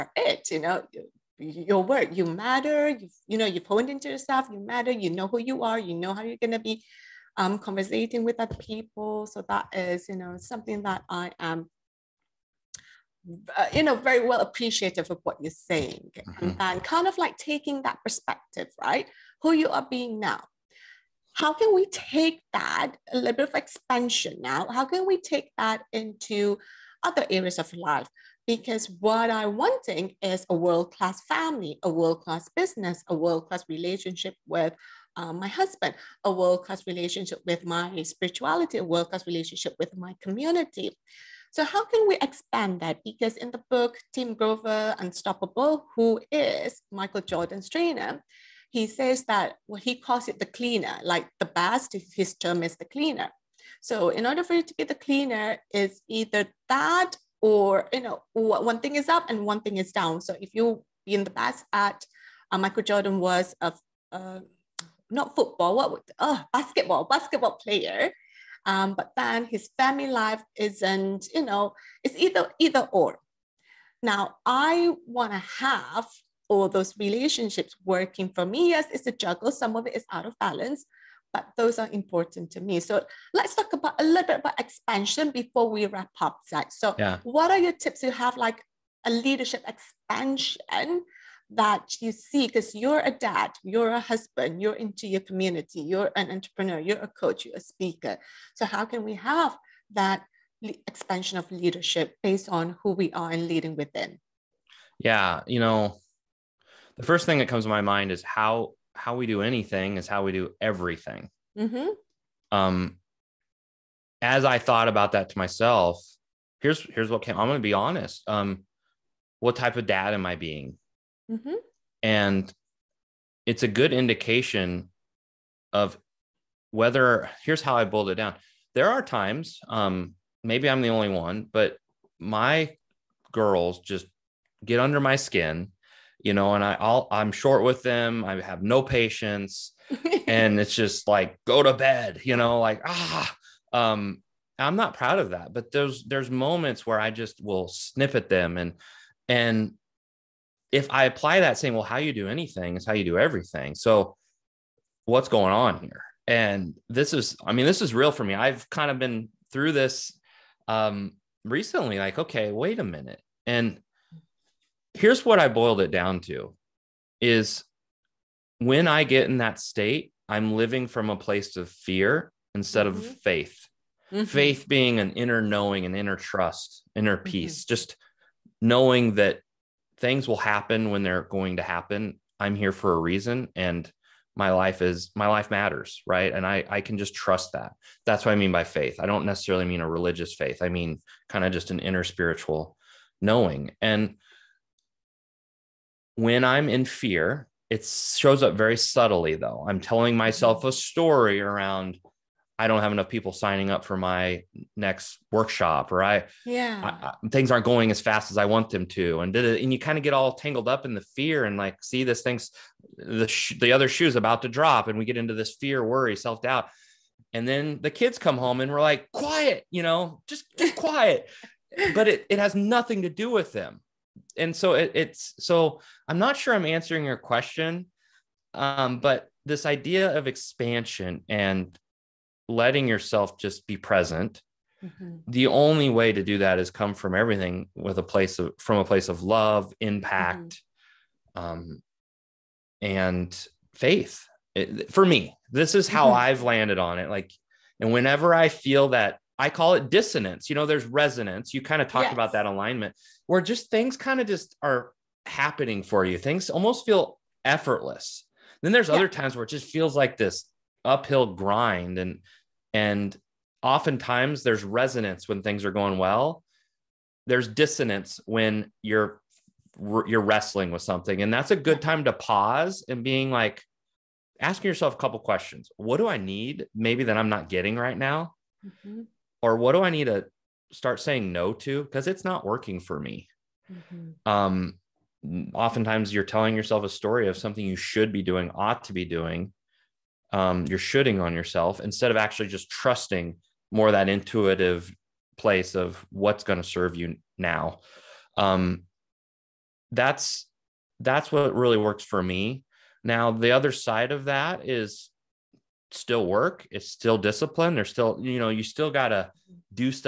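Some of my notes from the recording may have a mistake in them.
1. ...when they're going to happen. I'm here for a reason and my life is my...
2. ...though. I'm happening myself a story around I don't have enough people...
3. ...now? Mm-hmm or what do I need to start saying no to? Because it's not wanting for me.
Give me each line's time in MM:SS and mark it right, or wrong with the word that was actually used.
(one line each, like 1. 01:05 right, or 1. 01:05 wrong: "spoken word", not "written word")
1. 03:00 right
2. 03:19 wrong: "telling", not "happening"
3. 04:37 wrong: "working", not "wanting".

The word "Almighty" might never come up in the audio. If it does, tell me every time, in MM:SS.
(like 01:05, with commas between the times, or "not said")
not said.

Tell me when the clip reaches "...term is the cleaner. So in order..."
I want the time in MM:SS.
00:52.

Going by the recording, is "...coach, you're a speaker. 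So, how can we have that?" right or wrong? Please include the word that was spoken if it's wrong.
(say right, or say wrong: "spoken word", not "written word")
right.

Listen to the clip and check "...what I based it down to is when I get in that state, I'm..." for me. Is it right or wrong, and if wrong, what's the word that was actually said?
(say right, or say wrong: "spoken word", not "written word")
wrong: "boiled", not "based".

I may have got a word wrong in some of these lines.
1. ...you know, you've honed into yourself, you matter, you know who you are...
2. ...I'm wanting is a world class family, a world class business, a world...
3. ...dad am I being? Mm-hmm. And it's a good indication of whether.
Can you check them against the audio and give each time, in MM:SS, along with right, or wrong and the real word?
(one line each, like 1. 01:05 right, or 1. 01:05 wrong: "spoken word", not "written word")
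1. 00:03 right
2. 00:29 right
3. 01:59 right.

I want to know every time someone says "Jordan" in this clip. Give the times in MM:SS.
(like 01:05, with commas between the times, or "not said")
00:47, 01:02.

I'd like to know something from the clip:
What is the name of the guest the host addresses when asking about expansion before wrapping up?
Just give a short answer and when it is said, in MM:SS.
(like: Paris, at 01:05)
Zach, at 01:26.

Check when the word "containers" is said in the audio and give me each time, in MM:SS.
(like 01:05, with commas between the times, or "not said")
not said.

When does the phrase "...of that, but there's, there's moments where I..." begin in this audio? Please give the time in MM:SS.
02:25.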